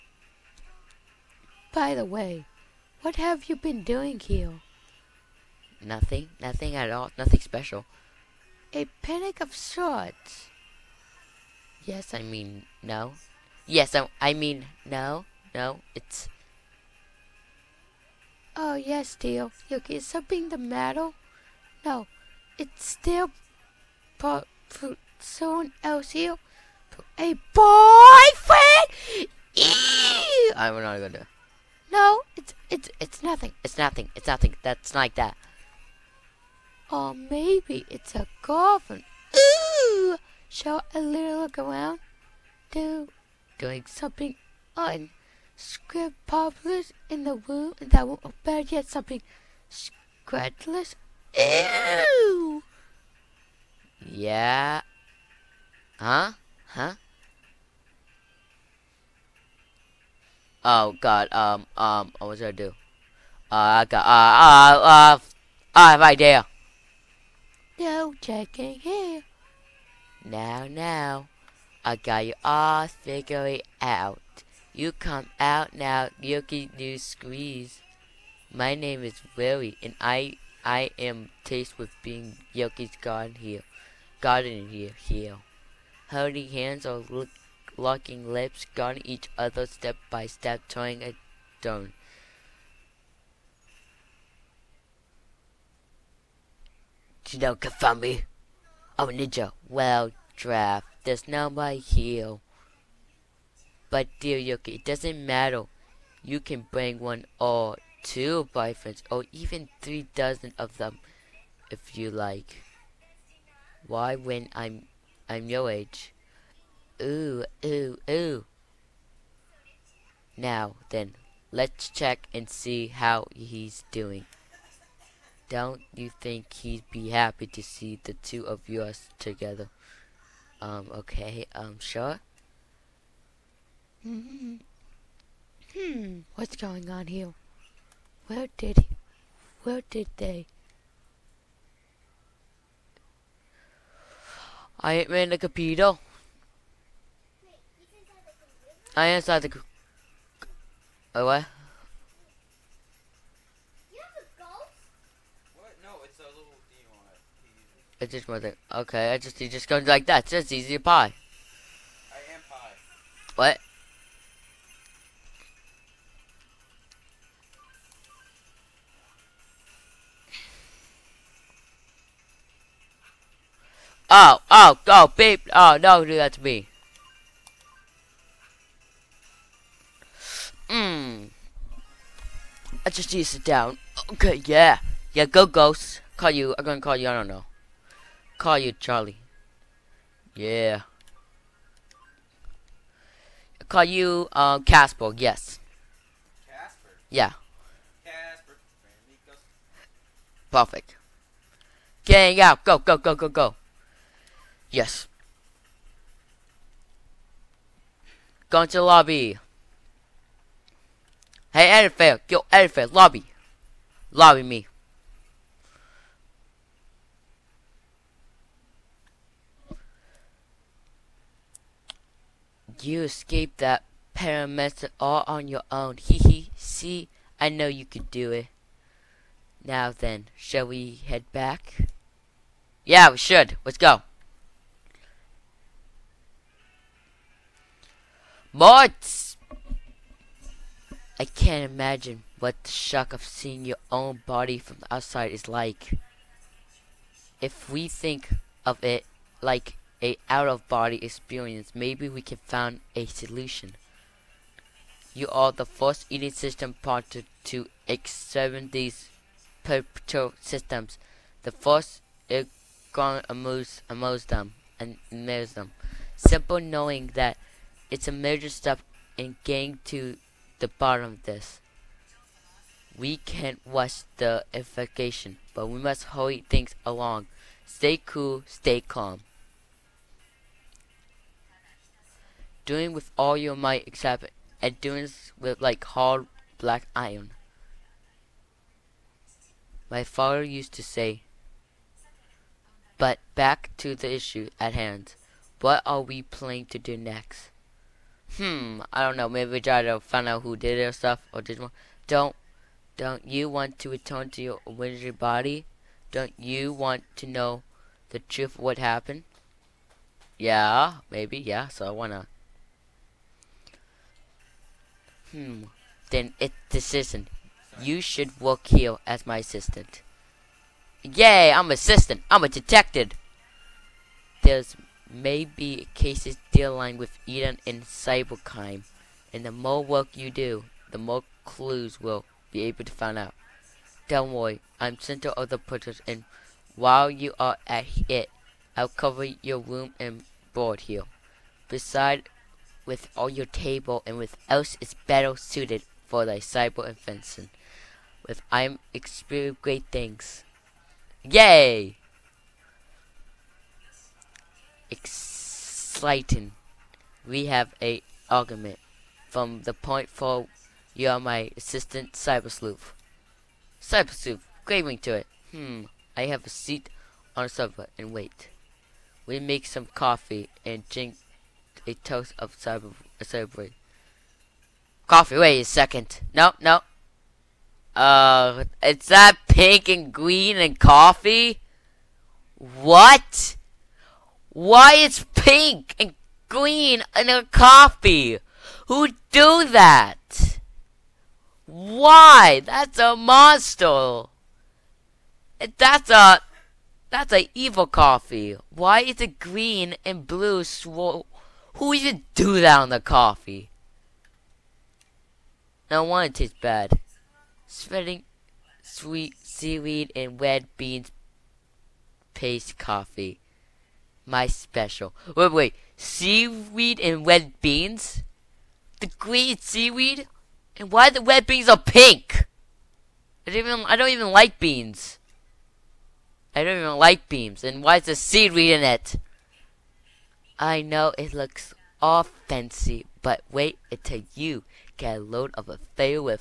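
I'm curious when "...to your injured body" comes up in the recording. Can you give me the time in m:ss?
5:04.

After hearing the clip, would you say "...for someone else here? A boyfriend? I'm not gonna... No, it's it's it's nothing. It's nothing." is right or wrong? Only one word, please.
right.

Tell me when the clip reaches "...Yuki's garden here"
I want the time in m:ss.
1:22.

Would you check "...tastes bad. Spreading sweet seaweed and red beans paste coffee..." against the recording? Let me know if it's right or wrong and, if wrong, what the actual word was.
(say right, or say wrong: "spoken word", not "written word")
right.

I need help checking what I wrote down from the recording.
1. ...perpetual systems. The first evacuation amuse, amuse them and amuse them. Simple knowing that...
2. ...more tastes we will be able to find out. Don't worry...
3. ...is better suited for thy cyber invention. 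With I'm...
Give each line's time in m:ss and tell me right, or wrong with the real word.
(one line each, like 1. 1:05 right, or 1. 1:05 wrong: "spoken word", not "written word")
1. 4:19 wrong: "ergon", not "evacuation"
2. 5:30 wrong: "clues", not "tastes"
3. 5:44 right.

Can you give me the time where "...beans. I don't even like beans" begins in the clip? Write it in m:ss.
7:04.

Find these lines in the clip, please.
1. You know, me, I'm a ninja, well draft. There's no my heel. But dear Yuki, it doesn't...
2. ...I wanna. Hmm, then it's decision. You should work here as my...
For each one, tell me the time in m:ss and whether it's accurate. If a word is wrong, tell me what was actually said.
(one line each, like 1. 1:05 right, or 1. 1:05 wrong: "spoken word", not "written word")
1. 1:37 right
2. 5:11 right.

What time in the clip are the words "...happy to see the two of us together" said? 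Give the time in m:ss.
2:07.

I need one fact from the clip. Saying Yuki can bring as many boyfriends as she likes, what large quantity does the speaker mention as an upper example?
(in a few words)
three dozen.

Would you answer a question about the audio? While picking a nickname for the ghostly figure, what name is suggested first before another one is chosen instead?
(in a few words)
Charlie.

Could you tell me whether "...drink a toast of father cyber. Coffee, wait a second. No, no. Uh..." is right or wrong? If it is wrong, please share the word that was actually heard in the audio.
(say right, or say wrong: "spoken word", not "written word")
wrong: "cyber", not "father".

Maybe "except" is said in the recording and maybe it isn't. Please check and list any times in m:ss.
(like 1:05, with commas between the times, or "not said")
4:43.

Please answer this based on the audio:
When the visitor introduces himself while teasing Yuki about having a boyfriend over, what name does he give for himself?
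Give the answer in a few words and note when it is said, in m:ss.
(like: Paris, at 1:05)
Willie, at 1:19.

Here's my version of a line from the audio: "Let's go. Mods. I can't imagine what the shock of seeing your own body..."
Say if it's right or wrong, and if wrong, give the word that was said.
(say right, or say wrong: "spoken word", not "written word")
right.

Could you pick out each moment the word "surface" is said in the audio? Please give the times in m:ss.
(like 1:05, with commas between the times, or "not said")
not said.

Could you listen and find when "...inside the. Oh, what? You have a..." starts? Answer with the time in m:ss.
2:29.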